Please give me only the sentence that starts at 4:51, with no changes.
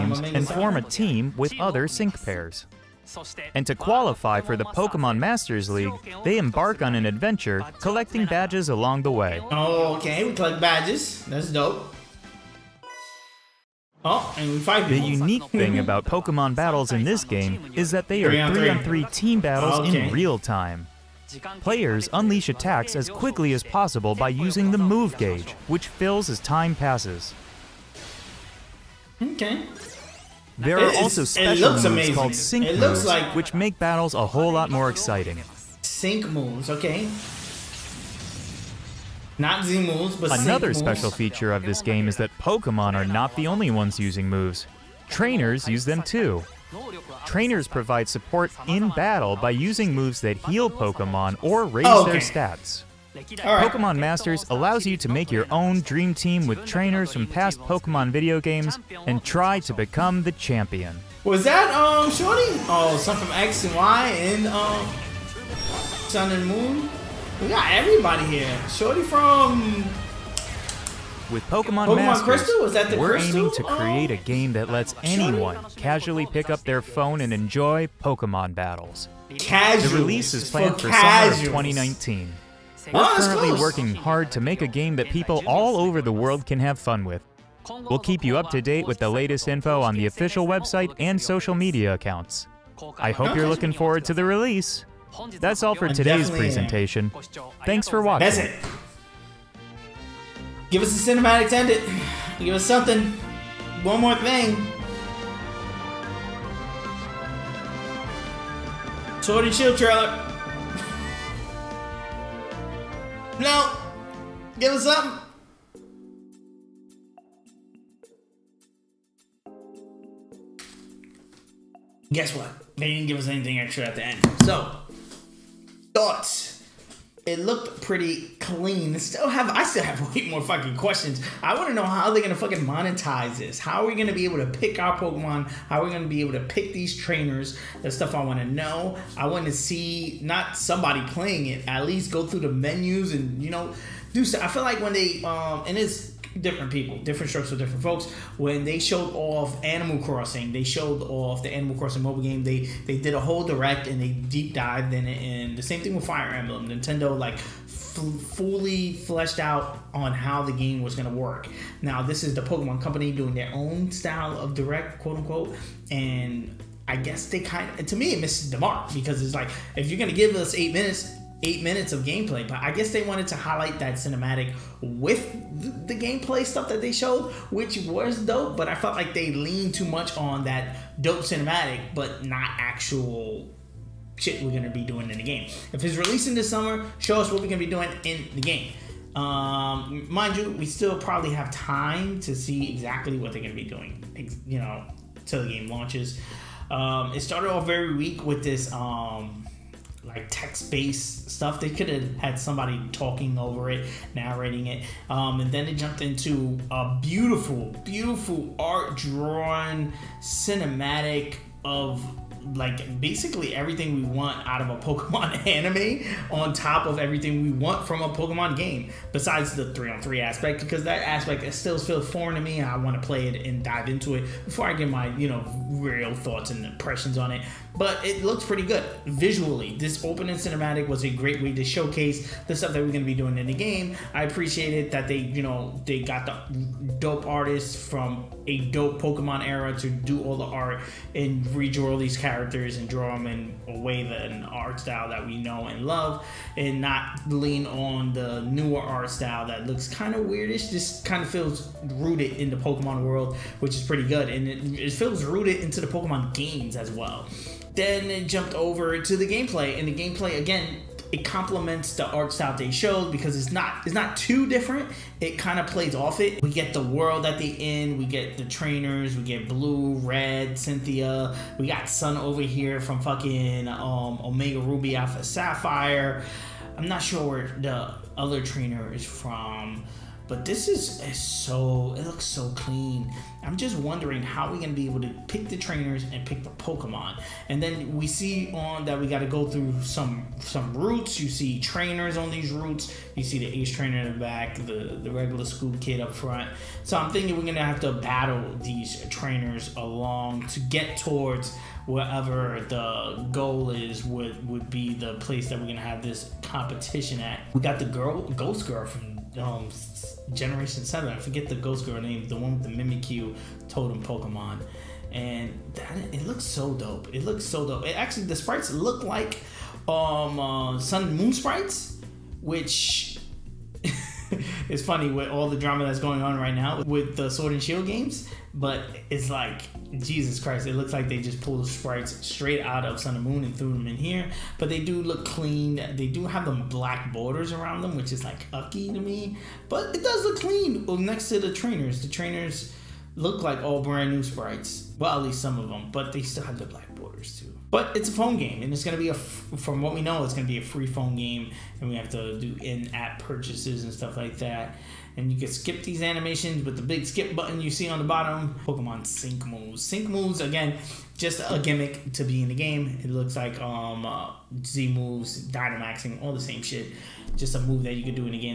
You see trainers on these routes.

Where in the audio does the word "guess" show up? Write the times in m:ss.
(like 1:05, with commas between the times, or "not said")
2:02, 2:46, 2:52.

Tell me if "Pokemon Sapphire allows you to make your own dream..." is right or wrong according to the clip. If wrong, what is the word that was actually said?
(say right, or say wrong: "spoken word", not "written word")
wrong: "Masters", not "Sapphire".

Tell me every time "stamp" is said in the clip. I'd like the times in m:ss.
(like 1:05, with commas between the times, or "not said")
not said.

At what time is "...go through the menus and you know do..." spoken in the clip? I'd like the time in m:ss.
2:22.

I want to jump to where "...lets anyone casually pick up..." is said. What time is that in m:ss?
1:14.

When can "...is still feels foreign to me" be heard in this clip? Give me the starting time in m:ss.
3:41.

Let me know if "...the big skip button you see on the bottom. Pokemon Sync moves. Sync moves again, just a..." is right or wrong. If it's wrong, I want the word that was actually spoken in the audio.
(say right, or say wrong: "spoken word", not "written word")
right.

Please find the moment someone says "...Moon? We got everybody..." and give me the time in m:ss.
1:06.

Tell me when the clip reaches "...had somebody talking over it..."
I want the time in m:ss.
3:22.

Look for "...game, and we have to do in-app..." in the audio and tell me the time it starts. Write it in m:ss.
5:51.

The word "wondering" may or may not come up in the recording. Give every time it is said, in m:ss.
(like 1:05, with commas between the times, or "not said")
4:43.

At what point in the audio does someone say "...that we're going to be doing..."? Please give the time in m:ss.
3:52.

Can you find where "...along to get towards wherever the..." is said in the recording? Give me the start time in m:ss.
4:59.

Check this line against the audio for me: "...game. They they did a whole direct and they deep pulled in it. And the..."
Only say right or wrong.
wrong.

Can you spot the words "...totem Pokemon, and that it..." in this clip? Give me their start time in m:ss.
5:13.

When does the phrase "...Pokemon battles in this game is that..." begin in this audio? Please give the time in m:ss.
0:16.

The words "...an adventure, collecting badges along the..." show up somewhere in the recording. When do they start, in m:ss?
0:06.